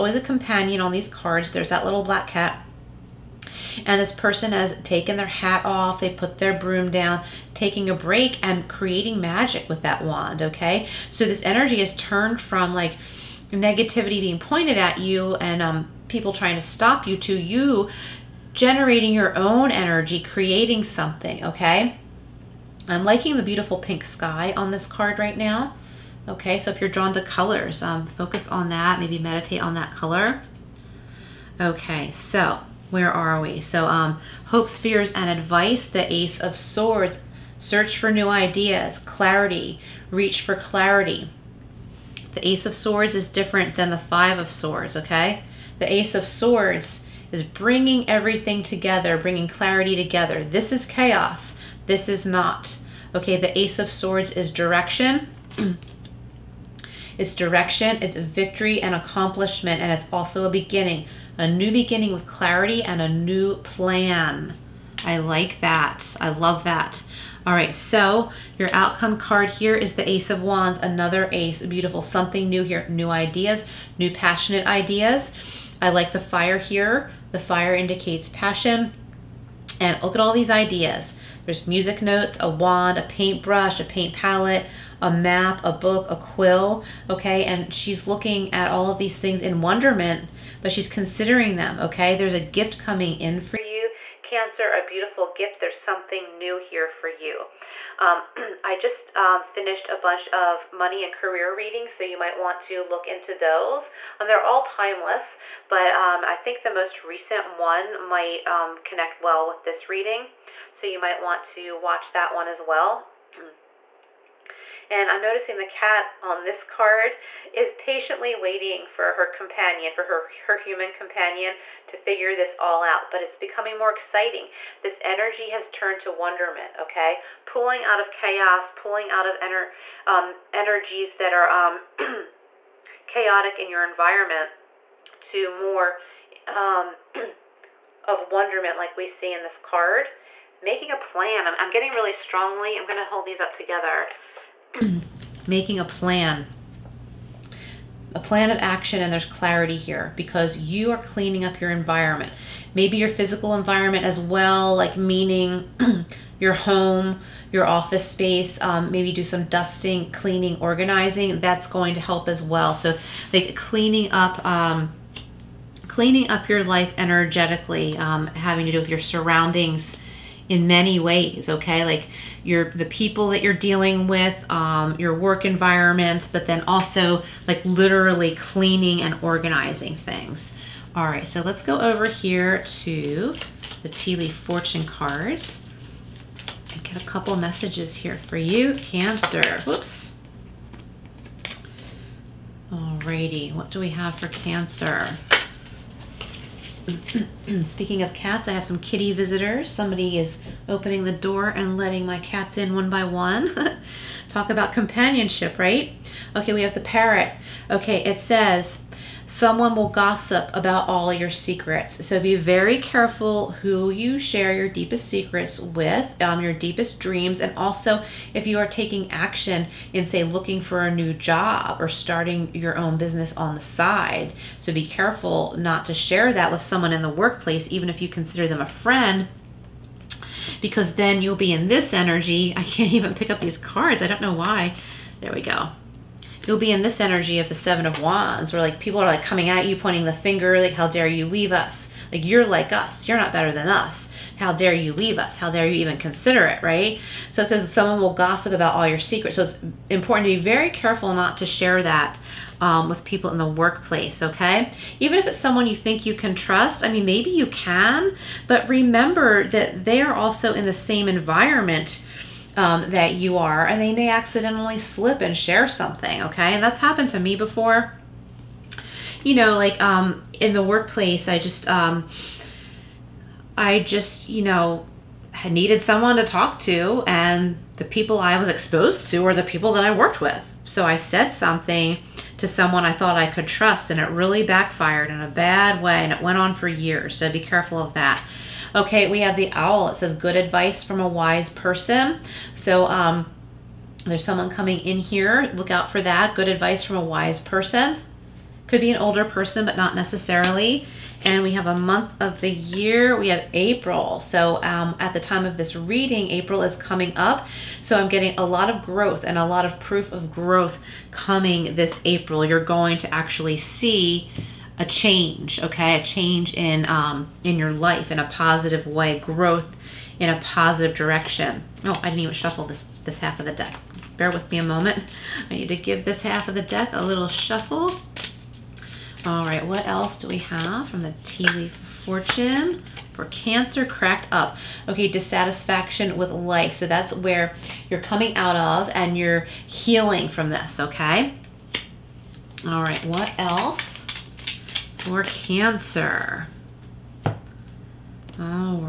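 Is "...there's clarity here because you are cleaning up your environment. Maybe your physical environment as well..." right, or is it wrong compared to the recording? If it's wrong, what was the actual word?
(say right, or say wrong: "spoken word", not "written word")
right.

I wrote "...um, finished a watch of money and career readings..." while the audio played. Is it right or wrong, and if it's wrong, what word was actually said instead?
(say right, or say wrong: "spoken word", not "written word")
wrong: "bunch", not "watch".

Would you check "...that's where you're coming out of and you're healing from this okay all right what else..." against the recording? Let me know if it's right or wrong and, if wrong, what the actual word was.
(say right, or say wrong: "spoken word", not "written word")
right.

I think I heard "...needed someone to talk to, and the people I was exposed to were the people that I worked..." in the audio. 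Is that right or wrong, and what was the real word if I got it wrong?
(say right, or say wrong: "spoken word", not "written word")
right.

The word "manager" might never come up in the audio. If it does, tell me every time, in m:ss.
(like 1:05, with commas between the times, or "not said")
not said.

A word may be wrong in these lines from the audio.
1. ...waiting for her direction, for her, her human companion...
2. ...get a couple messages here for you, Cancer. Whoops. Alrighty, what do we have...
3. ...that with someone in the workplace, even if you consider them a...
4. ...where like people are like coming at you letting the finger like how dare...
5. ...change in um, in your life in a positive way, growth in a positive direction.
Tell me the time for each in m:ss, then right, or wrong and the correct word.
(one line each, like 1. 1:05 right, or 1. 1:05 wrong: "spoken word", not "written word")
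1. 1:58 wrong: "companion", not "direction"
2. 3:06 right
3. 3:46 right
4. 3:58 wrong: "pointing", not "letting"
5. 5:16 right.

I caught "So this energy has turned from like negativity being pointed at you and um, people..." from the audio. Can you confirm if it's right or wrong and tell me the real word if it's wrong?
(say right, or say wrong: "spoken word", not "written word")
right.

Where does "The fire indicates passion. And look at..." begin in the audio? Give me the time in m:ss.
1:17.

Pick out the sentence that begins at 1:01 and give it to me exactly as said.
A new beginning with clarity and a new plan.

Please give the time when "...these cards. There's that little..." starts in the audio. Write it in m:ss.
0:00.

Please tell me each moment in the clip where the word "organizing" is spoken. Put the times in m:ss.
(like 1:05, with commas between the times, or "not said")
2:40, 2:59.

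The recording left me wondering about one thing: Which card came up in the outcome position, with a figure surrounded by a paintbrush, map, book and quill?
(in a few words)
Ace of Wands.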